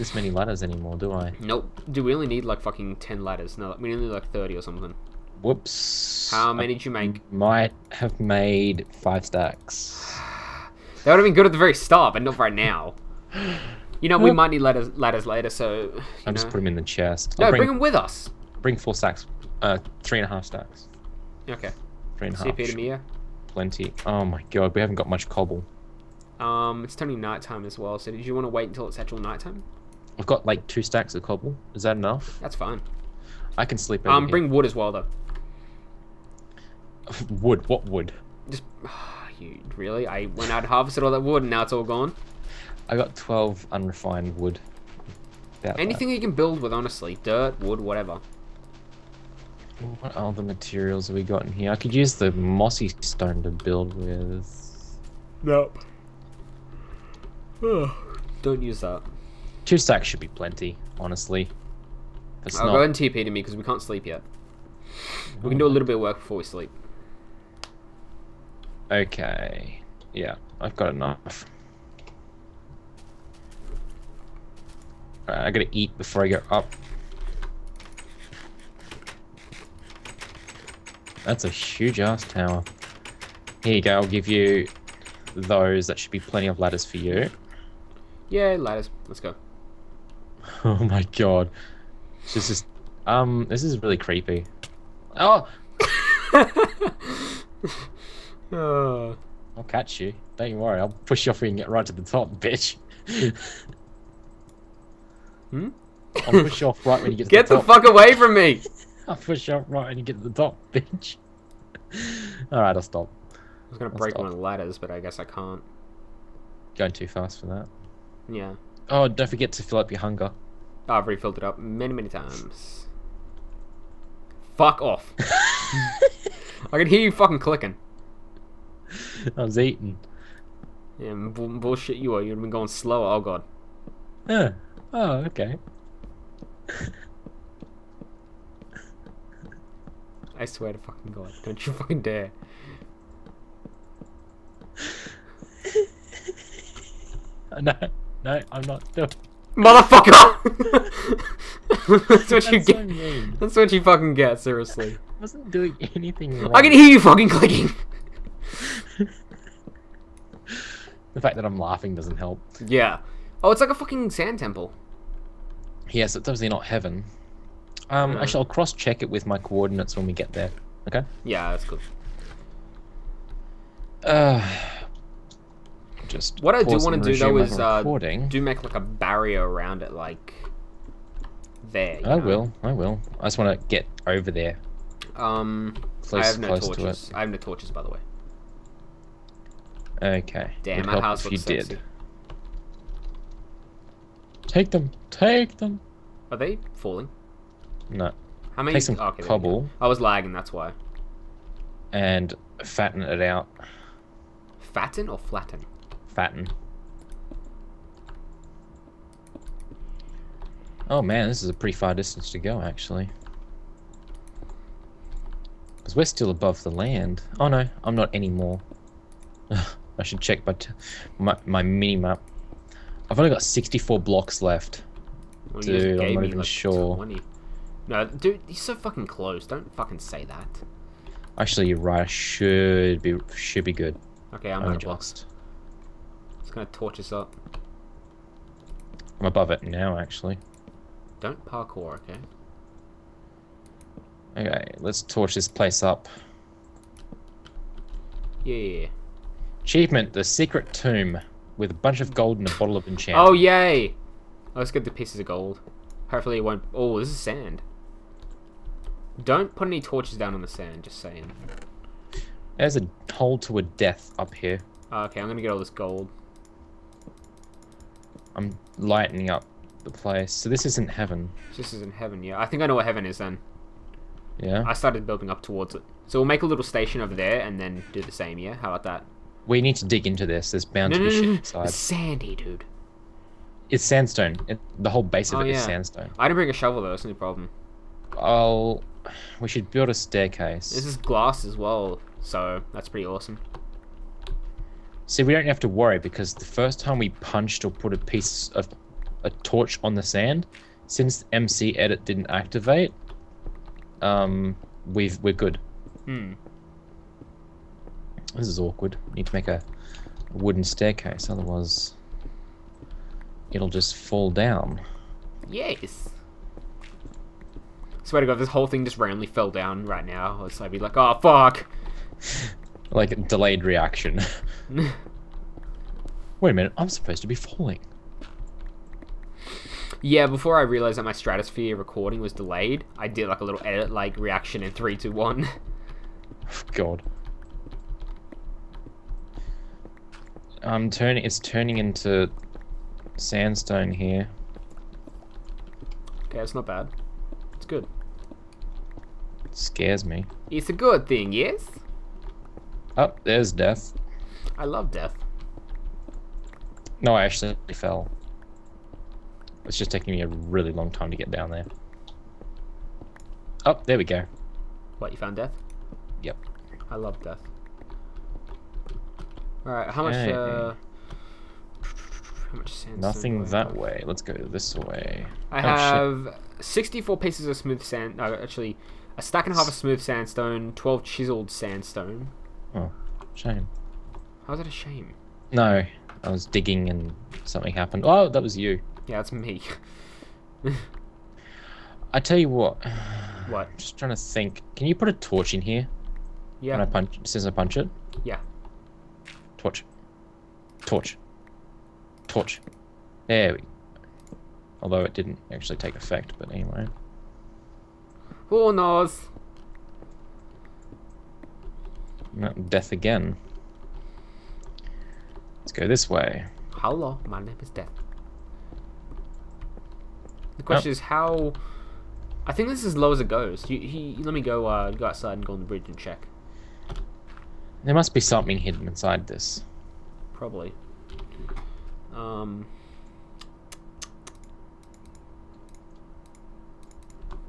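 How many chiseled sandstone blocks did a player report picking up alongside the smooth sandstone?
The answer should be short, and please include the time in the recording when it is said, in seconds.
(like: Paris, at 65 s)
12, at 380 s.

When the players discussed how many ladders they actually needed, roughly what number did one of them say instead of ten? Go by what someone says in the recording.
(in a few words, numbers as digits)
30.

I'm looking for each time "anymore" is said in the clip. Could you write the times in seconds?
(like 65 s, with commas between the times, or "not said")
0 s, 218 s.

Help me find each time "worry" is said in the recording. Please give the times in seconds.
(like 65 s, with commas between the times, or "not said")
100 s, 295 s.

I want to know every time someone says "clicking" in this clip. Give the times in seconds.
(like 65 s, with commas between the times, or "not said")
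127 s, 157 s.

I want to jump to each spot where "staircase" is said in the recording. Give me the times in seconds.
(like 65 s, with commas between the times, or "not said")
289 s, 310 s.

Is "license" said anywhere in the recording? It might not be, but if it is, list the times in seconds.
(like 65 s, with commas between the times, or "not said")
not said.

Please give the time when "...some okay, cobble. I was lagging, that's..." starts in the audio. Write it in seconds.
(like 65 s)
198 s.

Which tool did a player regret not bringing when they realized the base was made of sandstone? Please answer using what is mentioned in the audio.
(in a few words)
shovel.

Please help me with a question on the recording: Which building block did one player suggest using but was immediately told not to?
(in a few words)
mossy stone.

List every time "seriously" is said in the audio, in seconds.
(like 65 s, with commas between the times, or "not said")
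154 s.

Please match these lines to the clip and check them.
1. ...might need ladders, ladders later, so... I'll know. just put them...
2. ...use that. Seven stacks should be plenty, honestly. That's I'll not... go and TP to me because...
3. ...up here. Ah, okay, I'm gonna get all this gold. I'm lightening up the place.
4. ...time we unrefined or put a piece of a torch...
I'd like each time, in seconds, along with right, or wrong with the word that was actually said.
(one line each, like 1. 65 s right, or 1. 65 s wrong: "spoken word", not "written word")
1. 14 s right
2. 58 s wrong: "Two", not "Seven"
3. 264 s right
4. 296 s wrong: "punched", not "unrefined".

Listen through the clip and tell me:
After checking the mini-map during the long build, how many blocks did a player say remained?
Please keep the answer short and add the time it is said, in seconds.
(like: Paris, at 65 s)
64, at 223 s.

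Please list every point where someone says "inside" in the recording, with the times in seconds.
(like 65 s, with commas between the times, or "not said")
281 s, 428 s.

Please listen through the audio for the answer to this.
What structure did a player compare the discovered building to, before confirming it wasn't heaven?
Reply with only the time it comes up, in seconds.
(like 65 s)
164 s.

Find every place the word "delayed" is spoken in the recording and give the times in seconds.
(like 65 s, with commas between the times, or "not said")
323 s, 332 s.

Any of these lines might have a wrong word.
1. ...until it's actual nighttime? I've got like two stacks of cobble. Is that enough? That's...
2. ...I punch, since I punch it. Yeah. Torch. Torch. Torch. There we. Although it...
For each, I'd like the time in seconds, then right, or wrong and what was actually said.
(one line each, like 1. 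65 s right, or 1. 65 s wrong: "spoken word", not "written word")
1. 28 s right
2. 396 s right.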